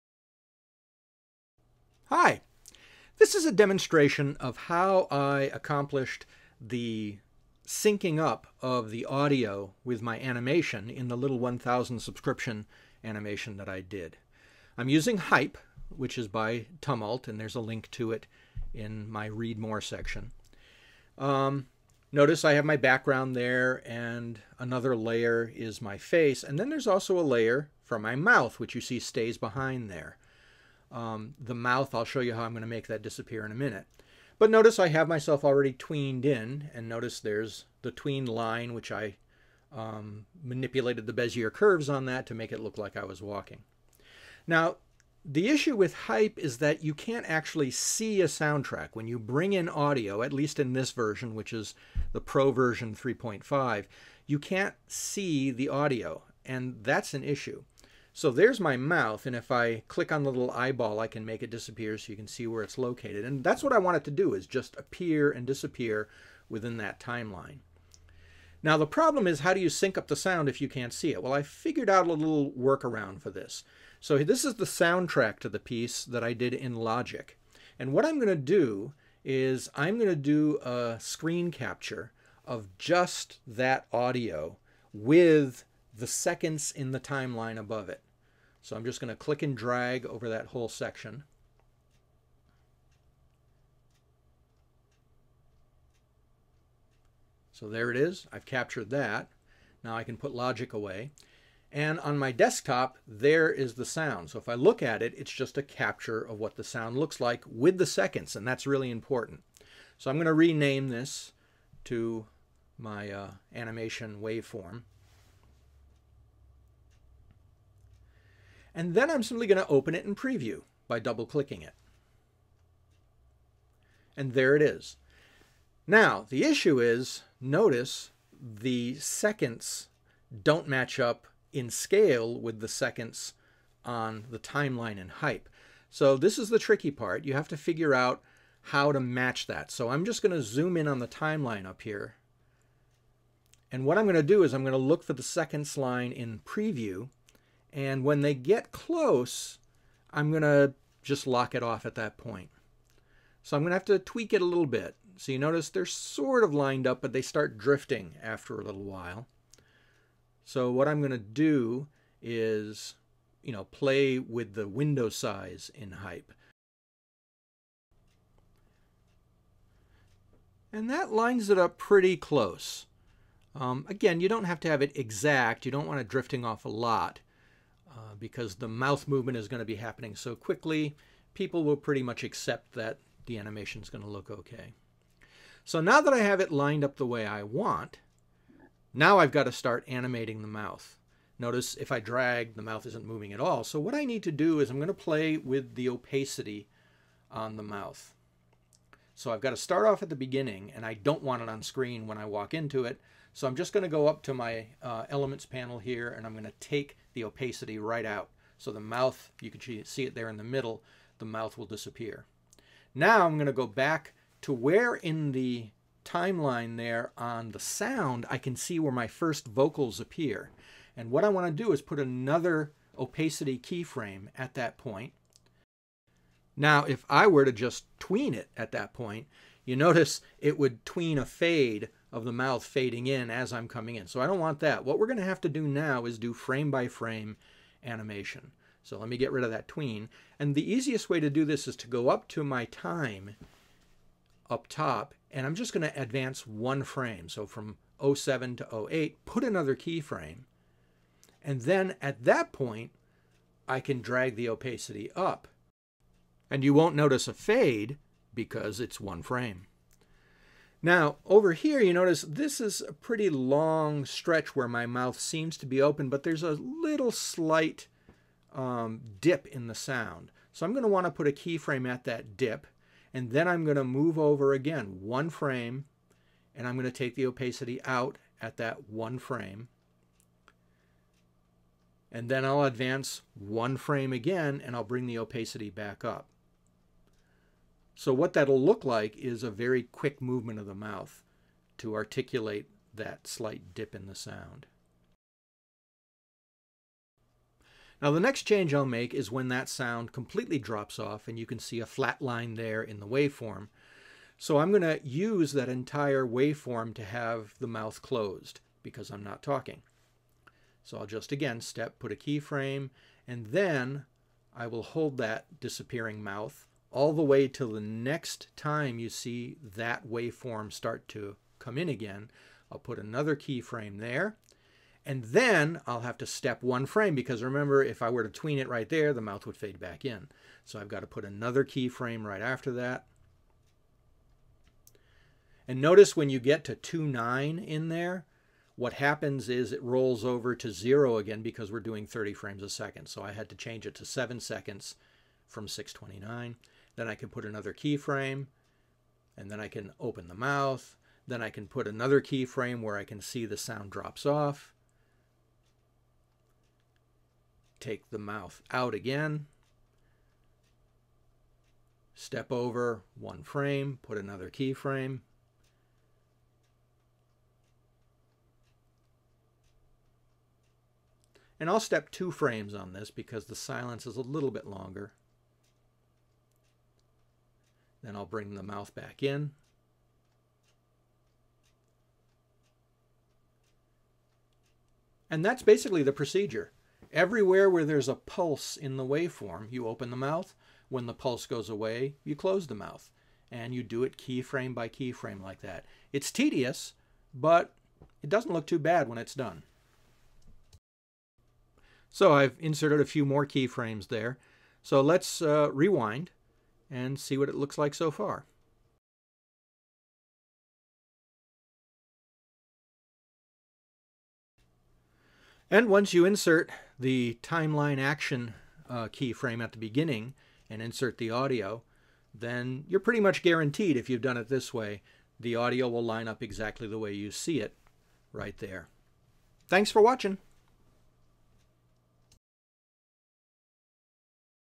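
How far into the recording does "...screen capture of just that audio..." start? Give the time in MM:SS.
01:20.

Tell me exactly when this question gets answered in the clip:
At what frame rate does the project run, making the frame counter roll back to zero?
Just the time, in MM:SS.
05:42.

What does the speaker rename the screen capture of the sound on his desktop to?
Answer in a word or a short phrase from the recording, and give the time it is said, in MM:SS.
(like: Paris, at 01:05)
animation waveform, at 01:53.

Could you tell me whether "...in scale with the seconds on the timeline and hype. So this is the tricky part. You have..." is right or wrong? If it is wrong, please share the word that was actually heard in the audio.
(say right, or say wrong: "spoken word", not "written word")
right.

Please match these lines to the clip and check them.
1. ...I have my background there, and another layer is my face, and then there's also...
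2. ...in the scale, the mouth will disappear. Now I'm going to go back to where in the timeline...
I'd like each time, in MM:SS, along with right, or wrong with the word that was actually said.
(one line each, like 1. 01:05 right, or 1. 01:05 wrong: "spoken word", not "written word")
1. 00:22 right
2. 03:30 wrong: "middle", not "scale".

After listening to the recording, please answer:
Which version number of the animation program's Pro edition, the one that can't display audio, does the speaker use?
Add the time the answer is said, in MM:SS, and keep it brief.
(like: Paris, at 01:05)
3.5, at 00:52.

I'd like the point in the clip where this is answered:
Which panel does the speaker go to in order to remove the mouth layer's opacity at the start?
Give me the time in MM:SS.
03:25.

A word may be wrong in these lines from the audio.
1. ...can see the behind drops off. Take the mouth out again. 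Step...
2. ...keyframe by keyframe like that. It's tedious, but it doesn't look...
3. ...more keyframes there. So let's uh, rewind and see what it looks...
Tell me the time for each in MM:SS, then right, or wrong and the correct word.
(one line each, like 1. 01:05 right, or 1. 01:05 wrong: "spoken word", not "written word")
1. 05:53 wrong: "sound", not "behind"
2. 06:34 right
3. 06:43 right.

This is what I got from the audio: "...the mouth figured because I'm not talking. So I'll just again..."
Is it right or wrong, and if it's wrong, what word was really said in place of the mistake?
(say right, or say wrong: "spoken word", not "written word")
wrong: "closed", not "figured".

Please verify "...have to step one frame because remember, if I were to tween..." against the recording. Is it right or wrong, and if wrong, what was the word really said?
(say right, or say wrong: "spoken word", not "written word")
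right.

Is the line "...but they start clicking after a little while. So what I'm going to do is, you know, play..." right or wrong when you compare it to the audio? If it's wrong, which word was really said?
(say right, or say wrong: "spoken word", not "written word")
wrong: "drifting", not "clicking".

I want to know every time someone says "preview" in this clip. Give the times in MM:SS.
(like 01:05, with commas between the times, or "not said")
02:00, 02:26.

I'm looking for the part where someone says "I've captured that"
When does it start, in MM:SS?
01:38.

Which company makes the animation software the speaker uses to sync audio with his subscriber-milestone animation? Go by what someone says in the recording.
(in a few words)
Tumult.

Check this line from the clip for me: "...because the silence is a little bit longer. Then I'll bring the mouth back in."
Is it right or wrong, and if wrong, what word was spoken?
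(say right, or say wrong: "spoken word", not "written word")
right.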